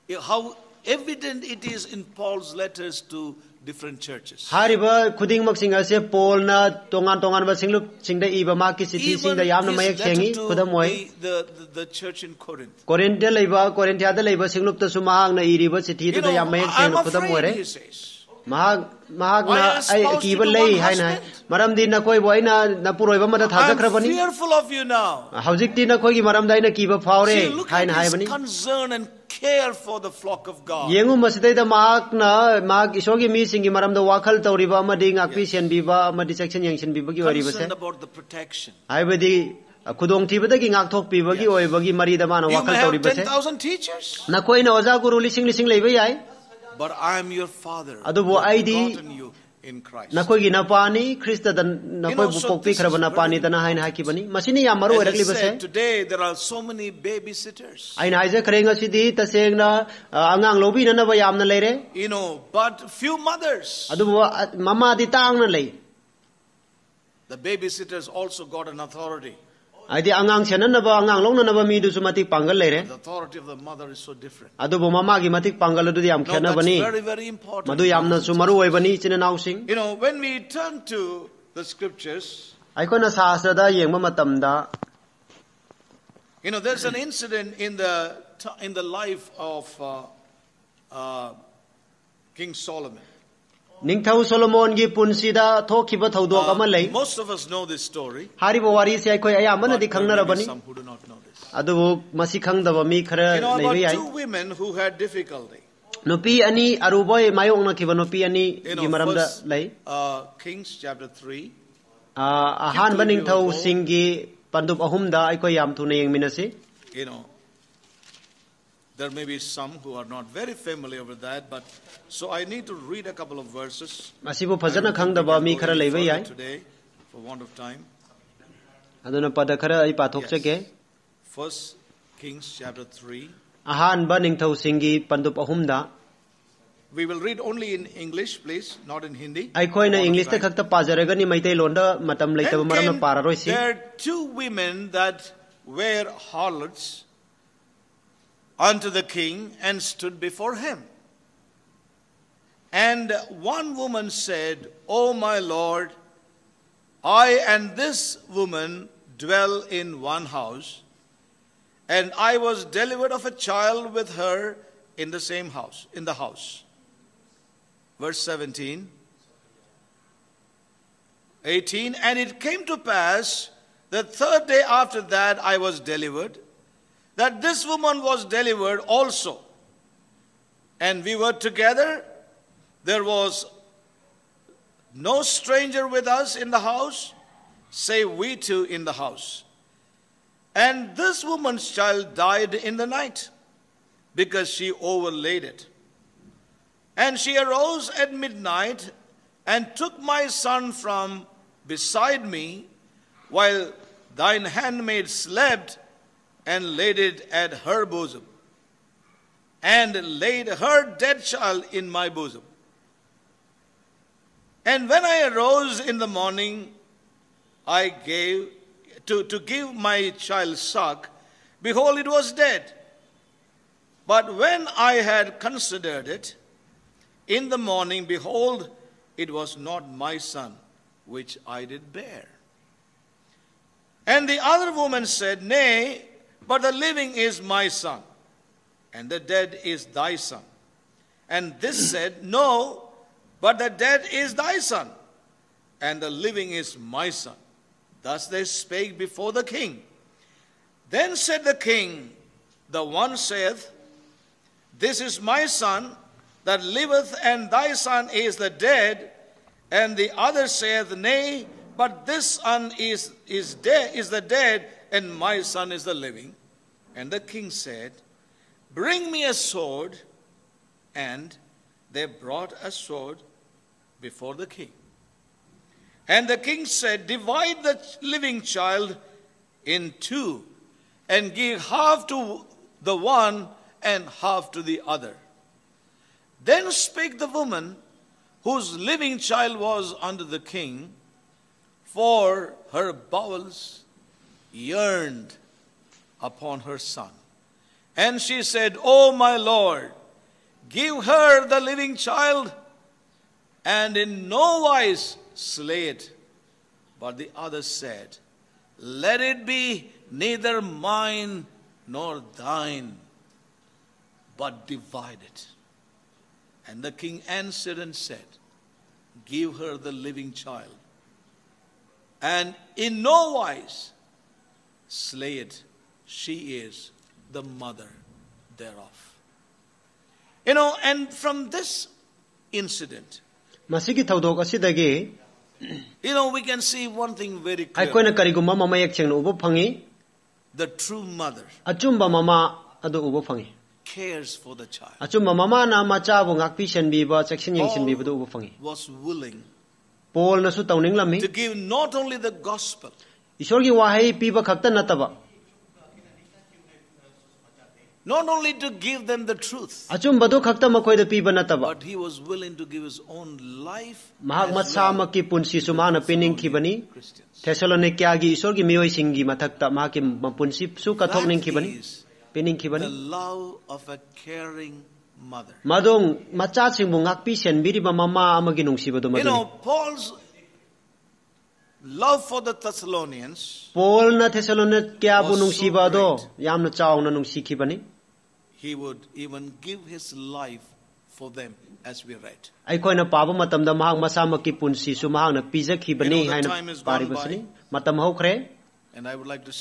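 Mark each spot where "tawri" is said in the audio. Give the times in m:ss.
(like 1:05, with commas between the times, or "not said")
0:34, 0:42.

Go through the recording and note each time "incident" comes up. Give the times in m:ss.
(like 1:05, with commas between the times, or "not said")
1:26, 5:32.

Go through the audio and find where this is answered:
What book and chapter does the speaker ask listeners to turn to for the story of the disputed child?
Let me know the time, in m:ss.
2:11.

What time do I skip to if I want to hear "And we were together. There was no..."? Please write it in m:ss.
3:00.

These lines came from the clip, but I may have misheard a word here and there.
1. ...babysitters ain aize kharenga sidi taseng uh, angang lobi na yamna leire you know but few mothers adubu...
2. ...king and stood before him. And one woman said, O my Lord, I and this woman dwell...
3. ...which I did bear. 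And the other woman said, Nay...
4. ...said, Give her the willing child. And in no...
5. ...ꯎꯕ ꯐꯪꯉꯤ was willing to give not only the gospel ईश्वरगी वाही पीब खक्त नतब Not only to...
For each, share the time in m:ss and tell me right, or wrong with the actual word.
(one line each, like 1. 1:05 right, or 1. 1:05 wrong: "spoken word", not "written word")
1. 0:56 right
2. 2:29 right
3. 3:51 right
4. 5:17 wrong: "living", not "willing"
5. 5:47 right.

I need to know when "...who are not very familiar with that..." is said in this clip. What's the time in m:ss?
1:59.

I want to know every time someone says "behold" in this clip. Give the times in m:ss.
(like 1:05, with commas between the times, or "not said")
3:41, 3:48.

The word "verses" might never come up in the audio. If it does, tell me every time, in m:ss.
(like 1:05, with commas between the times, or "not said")
2:03, 2:48.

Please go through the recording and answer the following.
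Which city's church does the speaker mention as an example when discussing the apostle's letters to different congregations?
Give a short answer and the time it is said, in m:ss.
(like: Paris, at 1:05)
Corinth, at 0:11.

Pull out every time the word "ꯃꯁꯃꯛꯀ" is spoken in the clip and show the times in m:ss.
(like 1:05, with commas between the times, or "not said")
6:04, 6:34.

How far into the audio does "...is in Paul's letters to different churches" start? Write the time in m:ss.
0:01.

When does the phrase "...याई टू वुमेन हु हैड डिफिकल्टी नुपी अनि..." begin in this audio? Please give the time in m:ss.
1:43.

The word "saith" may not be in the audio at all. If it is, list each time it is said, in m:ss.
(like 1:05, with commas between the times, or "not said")
4:13, 4:20.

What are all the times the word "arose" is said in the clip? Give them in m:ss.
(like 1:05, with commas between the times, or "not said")
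3:17, 3:35.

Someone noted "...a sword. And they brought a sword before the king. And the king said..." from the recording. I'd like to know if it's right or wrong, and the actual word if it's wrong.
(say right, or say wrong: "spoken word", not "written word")
right.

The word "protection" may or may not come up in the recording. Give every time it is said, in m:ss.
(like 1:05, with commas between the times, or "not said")
0:38.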